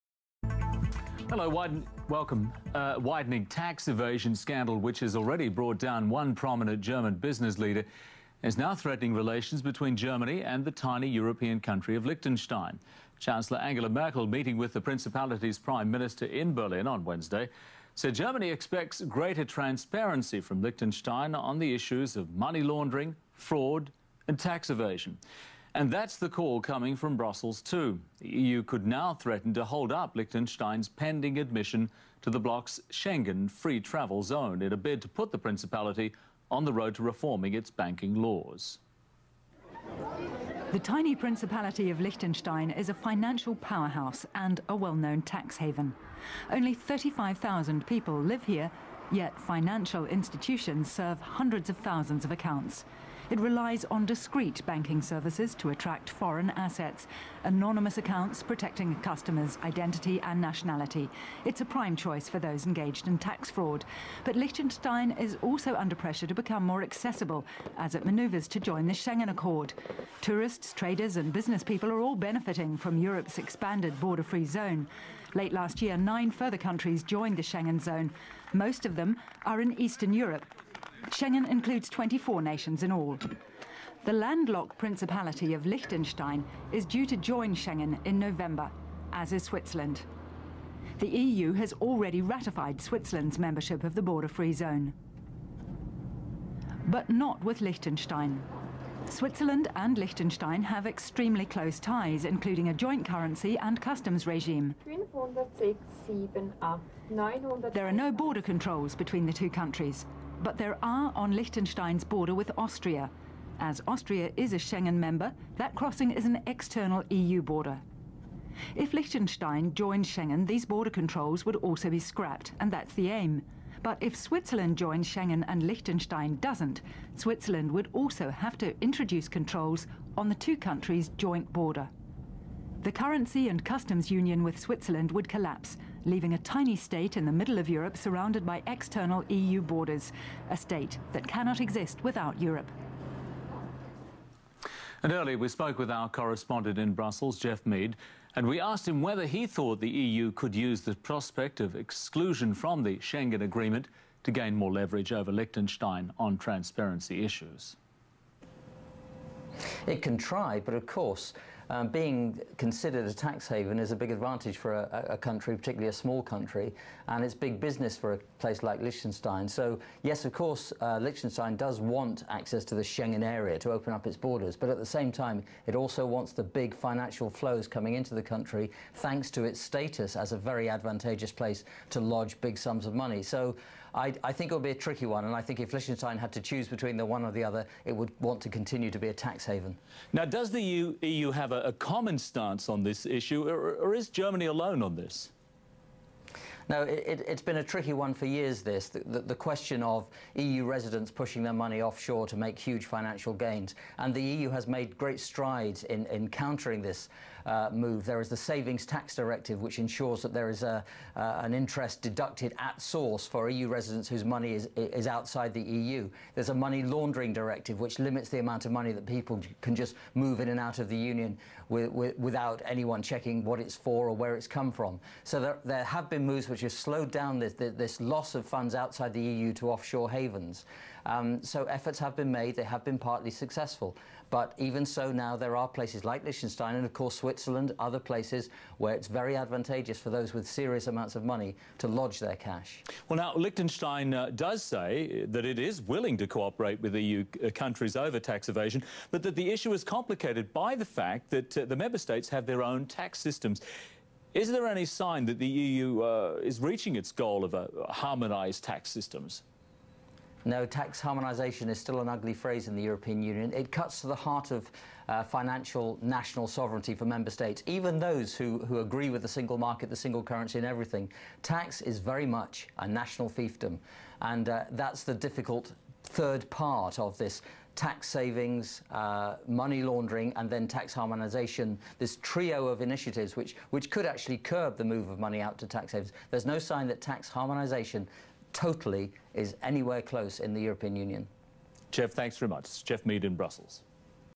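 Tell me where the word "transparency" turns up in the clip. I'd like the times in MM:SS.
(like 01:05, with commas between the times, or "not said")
00:19, 02:36.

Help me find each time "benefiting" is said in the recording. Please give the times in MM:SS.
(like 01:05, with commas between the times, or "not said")
01:12.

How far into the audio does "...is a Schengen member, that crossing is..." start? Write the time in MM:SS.
01:54.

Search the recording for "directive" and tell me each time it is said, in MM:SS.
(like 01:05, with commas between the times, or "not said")
03:29, 03:37.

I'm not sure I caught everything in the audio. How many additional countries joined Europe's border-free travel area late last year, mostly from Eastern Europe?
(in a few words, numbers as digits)
9.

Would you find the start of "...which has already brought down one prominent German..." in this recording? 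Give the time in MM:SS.
00:04.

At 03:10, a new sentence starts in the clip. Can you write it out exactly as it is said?
Now, does the EU, EU have a, a common stance on this issue, or, or is Germany alone on this?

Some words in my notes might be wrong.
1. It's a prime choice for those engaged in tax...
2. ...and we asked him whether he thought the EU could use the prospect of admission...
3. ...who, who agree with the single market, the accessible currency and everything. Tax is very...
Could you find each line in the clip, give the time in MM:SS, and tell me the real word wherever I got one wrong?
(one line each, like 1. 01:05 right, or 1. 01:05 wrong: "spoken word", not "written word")
1. 01:01 right
2. 02:28 wrong: "exclusion", not "admission"
3. 04:28 wrong: "single", not "accessible".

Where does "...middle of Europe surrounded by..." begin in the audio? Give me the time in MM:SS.
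02:17.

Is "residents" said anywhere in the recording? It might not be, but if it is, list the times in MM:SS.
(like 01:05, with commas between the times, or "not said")
03:20, 03:33.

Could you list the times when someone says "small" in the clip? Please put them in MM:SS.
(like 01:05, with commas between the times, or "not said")
02:45.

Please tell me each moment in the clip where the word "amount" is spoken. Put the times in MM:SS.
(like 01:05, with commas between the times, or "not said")
03:38, 04:00.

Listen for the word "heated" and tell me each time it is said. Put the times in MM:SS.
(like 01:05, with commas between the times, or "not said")
not said.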